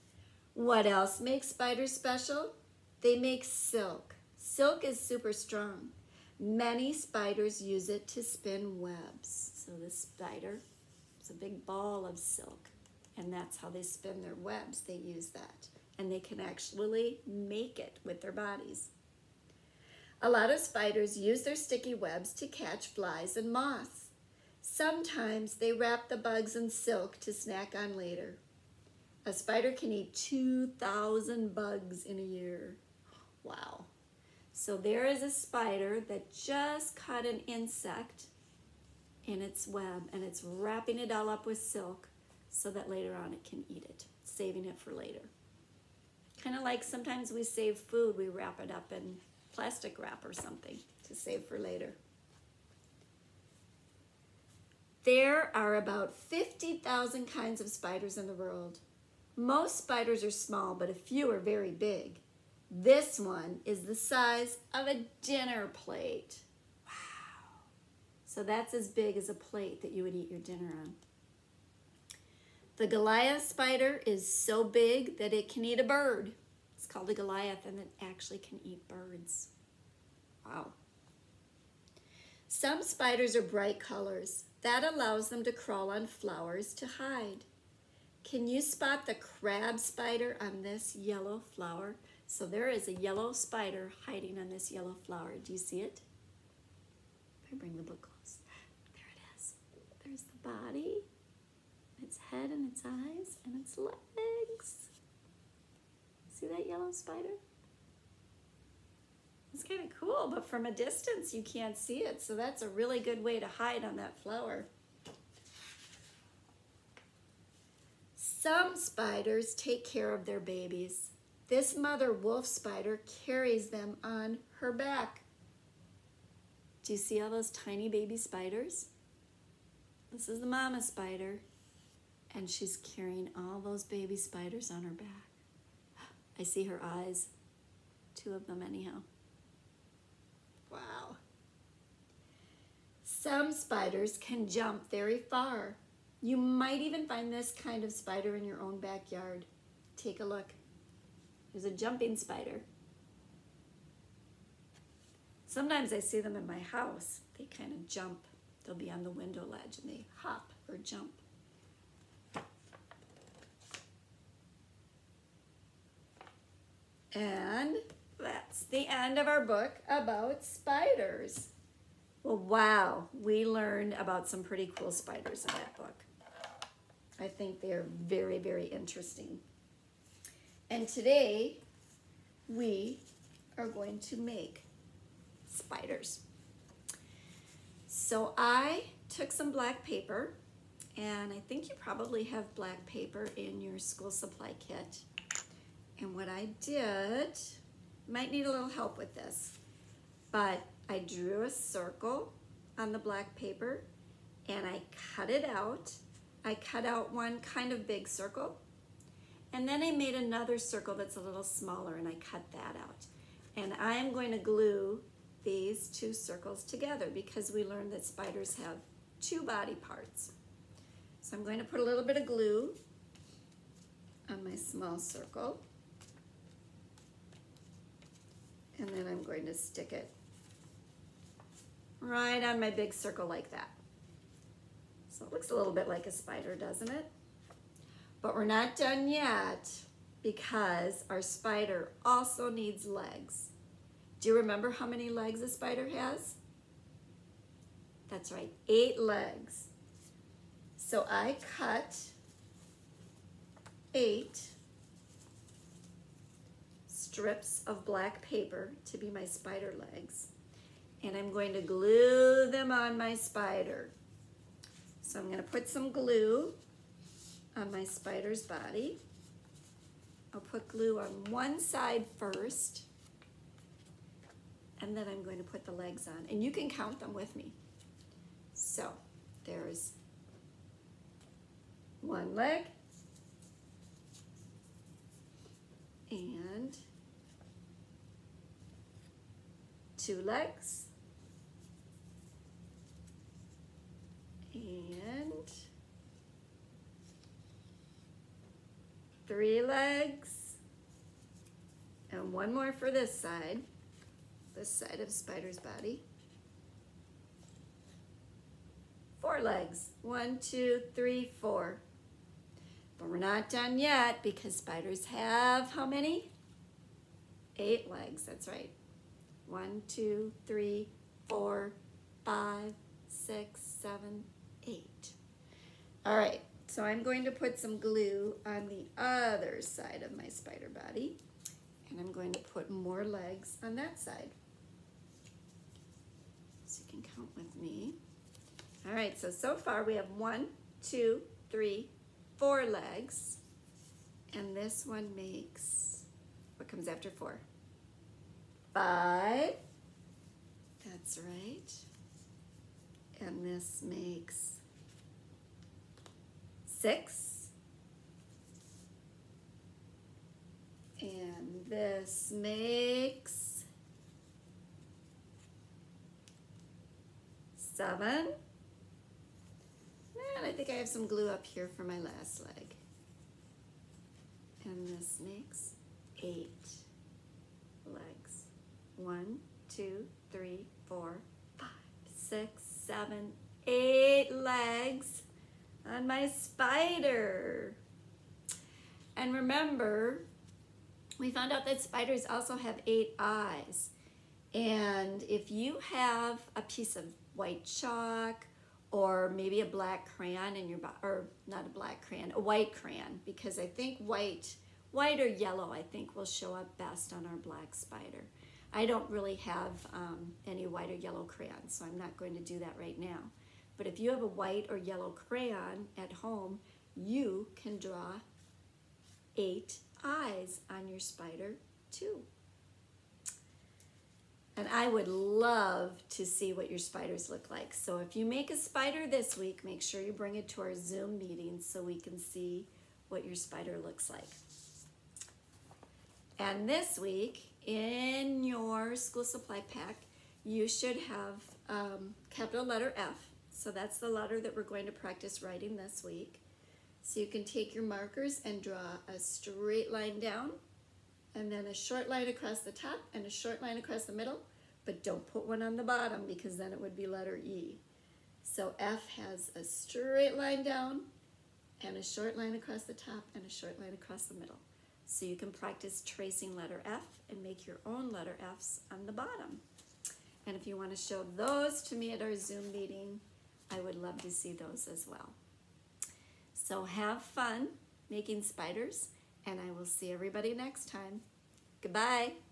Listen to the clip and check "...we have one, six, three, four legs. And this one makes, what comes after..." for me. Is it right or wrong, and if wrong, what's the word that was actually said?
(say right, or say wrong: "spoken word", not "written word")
wrong: "two", not "six".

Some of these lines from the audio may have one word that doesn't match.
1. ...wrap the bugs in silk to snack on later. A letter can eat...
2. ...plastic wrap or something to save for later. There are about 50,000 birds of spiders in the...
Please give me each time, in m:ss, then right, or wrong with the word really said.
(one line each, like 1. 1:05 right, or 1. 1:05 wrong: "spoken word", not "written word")
1. 0:25 wrong: "spider", not "letter"
2. 0:49 wrong: "kinds", not "birds".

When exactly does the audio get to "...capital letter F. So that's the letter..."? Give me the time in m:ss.
7:22.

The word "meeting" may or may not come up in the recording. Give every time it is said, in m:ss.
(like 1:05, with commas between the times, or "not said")
7:11, 7:52.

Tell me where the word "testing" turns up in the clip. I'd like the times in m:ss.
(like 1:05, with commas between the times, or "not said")
not said.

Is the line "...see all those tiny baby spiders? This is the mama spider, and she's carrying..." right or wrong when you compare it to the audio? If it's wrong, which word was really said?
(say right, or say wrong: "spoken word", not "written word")
right.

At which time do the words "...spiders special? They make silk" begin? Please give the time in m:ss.
0:01.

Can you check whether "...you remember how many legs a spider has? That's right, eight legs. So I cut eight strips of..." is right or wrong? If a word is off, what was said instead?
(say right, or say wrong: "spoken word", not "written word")
right.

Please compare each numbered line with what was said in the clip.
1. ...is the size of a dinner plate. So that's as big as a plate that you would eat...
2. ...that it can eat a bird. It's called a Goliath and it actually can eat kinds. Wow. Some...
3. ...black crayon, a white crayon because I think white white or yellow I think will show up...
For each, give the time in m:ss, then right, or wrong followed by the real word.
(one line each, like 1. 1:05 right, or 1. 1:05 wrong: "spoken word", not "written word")
1. 1:03 right
2. 1:15 wrong: "birds", not "kinds"
3. 6:41 right.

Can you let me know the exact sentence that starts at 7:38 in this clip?
So F has a straight line down and a short line across the top and a short line across the middle.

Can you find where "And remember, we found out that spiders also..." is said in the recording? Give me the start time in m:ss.
6:29.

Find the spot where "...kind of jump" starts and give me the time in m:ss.
2:37.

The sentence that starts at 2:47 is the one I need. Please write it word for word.
And that's the end of our book about spiders.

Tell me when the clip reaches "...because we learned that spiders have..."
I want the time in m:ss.
3:37.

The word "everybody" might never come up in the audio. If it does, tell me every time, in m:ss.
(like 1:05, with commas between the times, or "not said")
8:00.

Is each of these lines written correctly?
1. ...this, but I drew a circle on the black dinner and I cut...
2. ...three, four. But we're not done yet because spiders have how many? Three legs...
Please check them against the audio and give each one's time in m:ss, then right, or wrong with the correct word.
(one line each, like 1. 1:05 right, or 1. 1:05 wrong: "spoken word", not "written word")
1. 3:19 wrong: "paper", not "dinner"
2. 5:10 wrong: "Eight", not "Three".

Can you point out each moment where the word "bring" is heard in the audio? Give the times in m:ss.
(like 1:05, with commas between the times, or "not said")
1:37, 7:10.